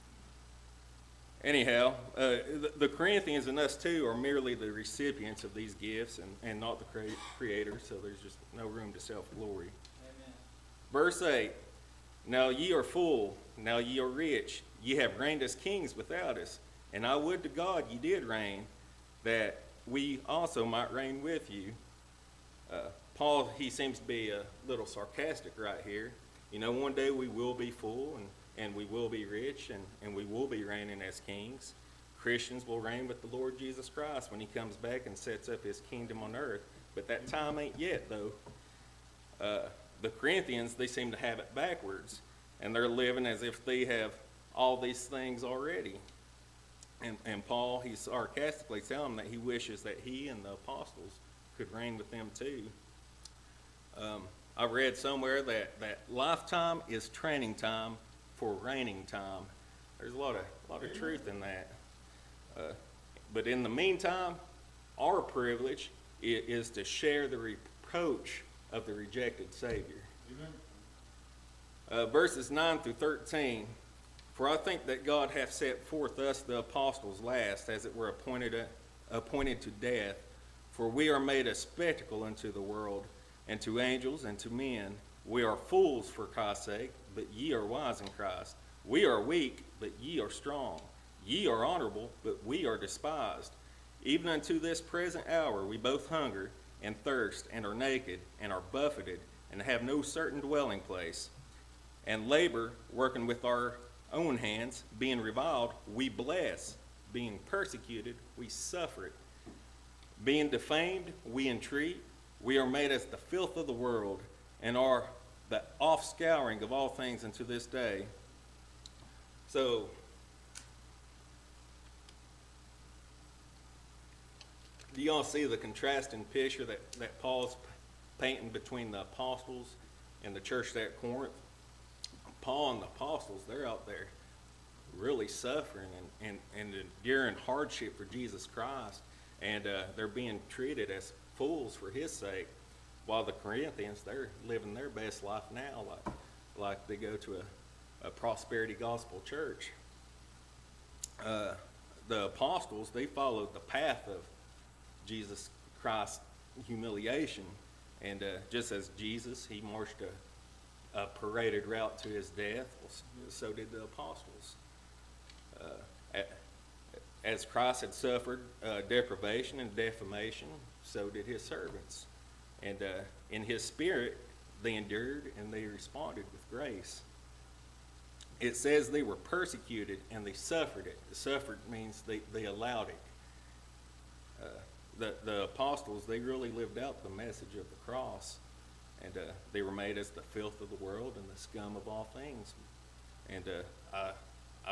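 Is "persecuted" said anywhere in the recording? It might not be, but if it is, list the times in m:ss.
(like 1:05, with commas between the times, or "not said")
1:47, 2:59.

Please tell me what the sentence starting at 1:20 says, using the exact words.
For we are made a spectacle unto the world, and to angels, and to men.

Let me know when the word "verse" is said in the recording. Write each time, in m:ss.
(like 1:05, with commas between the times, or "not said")
0:10, 1:12.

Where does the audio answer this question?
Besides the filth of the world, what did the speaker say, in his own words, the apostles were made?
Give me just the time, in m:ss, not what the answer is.
3:11.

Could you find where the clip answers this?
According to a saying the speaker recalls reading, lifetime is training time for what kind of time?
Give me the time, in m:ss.
0:58.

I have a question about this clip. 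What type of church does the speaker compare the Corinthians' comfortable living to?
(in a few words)
A prosperity gospel church.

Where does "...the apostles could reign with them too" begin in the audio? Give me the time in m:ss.
0:50.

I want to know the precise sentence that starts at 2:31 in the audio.
Uh, the apostles, they followed the path of Jesus Christ's humiliation.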